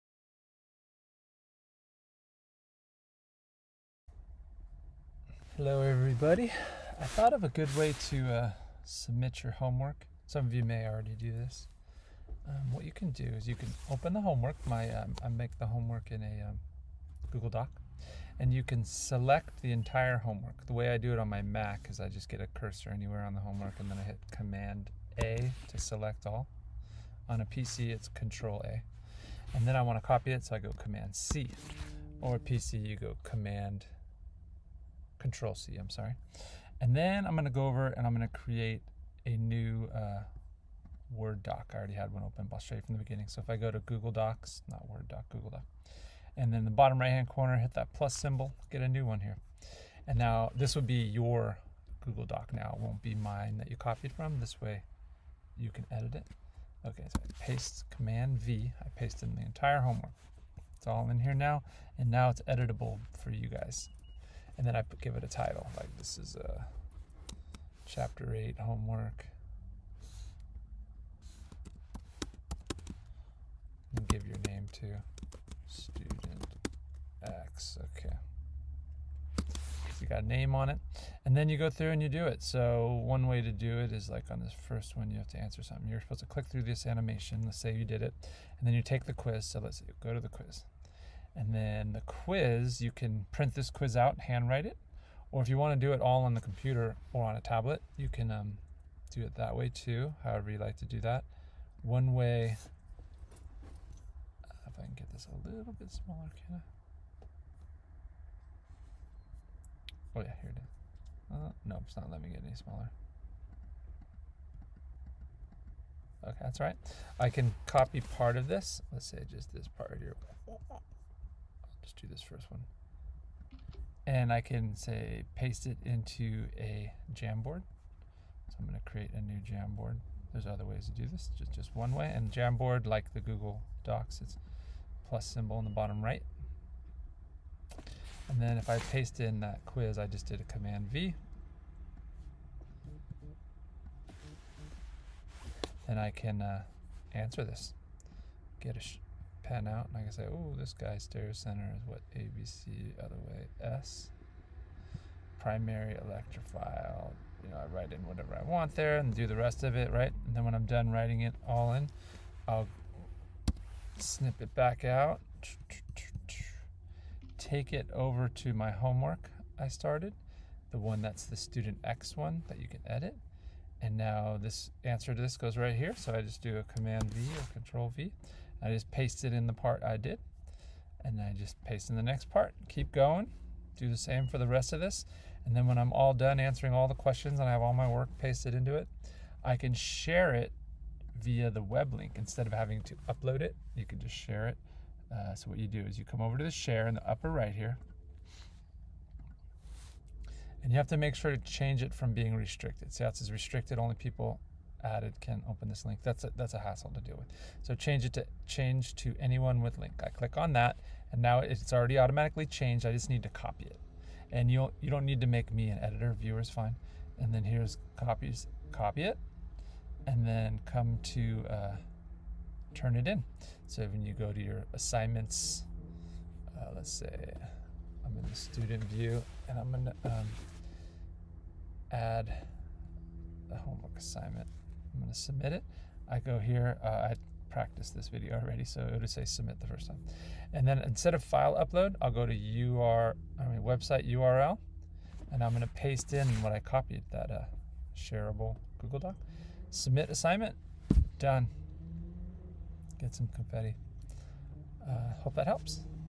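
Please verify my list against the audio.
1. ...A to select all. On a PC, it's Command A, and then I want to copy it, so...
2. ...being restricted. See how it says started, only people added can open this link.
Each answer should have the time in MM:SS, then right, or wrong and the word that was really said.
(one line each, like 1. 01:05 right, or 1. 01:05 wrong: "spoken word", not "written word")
1. 00:25 wrong: "Control", not "Command"
2. 03:22 wrong: "restricted", not "started".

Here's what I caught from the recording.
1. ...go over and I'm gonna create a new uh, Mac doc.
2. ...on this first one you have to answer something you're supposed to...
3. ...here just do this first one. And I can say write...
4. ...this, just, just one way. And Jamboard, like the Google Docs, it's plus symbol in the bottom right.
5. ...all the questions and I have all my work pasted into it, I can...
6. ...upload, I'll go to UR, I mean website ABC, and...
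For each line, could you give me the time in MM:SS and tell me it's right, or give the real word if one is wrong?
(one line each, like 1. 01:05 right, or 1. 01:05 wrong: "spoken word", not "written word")
1. 00:37 wrong: "Word", not "Mac"
2. 01:24 right
3. 01:59 wrong: "paste", not "write"
4. 02:11 right
5. 03:06 right
6. 04:01 wrong: "URL", not "ABC".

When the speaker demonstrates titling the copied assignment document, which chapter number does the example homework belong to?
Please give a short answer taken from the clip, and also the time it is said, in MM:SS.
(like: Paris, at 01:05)
8, at 01:07.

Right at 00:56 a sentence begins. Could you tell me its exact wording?
Okay, so I paste Command V.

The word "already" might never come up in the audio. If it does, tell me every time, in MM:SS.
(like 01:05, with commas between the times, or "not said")
00:10, 00:41, 03:31, 03:58.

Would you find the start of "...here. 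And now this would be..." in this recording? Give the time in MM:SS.
00:49.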